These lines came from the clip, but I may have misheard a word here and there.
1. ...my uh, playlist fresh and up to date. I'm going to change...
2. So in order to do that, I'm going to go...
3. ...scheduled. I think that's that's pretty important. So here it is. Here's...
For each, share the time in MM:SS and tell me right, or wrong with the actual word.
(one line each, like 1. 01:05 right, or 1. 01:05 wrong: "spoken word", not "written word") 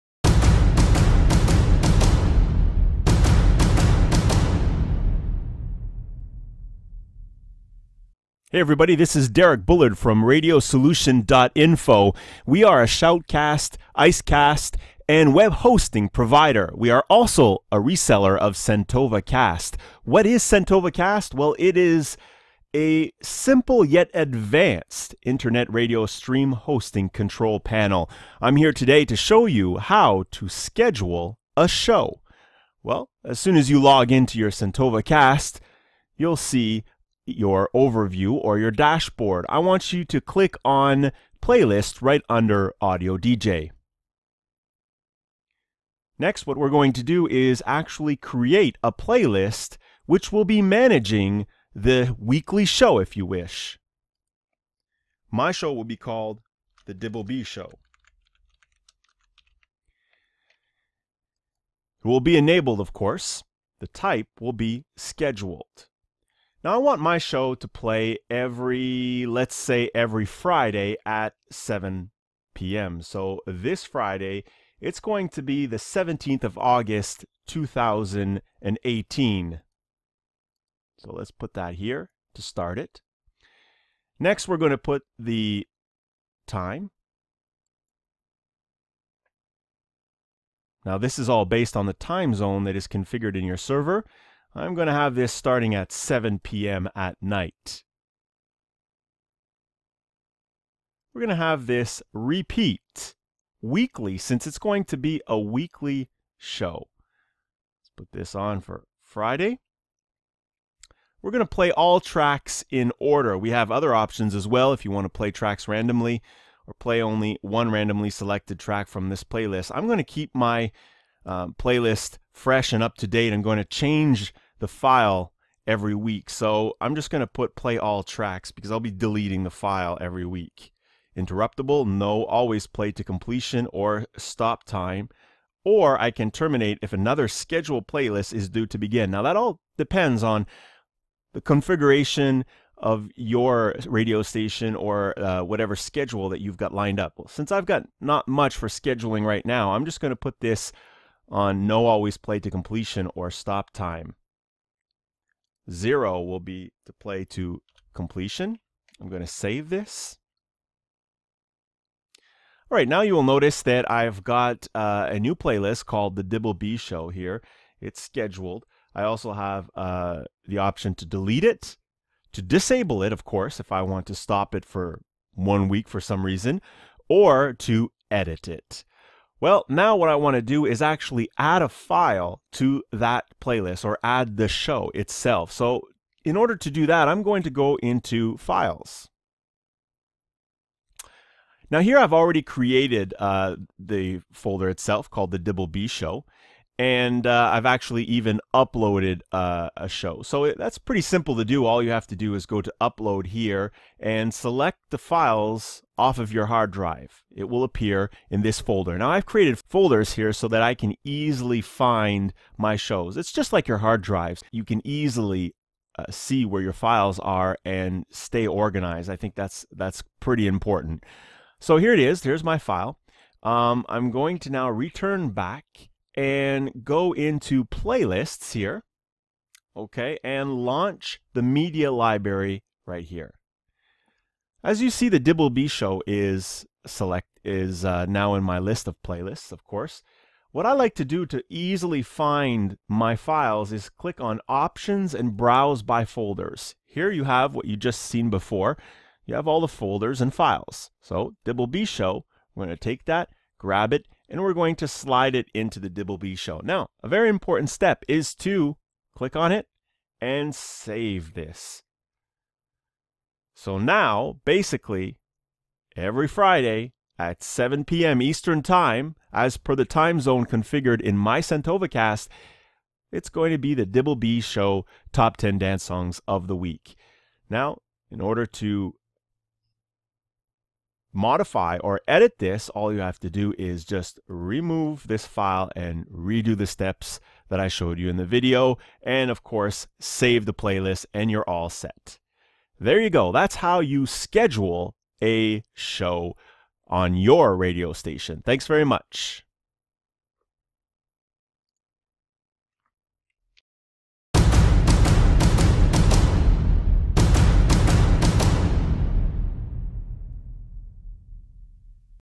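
1. 02:00 right
2. 03:05 right
3. 03:38 wrong: "organized", not "scheduled".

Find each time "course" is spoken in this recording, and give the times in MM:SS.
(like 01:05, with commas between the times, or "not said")
01:02, 02:53, 03:59, 04:49.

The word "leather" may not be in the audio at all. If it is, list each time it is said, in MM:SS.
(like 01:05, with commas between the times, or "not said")
not said.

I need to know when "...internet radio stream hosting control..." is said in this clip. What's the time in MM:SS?
00:25.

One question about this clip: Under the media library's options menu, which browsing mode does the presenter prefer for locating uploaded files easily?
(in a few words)
browse by folders.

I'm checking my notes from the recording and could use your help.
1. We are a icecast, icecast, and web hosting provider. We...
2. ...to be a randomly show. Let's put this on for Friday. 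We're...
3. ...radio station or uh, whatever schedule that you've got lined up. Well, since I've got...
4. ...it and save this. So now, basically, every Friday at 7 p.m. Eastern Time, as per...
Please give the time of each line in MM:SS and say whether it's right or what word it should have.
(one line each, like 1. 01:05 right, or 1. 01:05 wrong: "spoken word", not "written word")
1. 00:12 wrong: "shoutcast", not "icecast"
2. 01:44 wrong: "weekly", not "randomly"
3. 02:23 right
4. 04:19 right.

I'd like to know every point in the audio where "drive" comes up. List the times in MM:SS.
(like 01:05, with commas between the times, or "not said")
03:26, 03:34.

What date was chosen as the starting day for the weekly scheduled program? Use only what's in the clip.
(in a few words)
17 August 2018.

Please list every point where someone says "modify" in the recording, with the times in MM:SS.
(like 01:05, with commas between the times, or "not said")
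04:41.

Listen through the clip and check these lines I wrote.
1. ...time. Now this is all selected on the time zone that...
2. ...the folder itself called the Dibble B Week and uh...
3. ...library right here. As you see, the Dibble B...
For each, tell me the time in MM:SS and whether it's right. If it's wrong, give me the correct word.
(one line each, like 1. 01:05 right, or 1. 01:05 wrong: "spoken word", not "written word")
1. 01:26 wrong: "based", not "selected"
2. 03:13 wrong: "Show", not "Week"
3. 03:51 right.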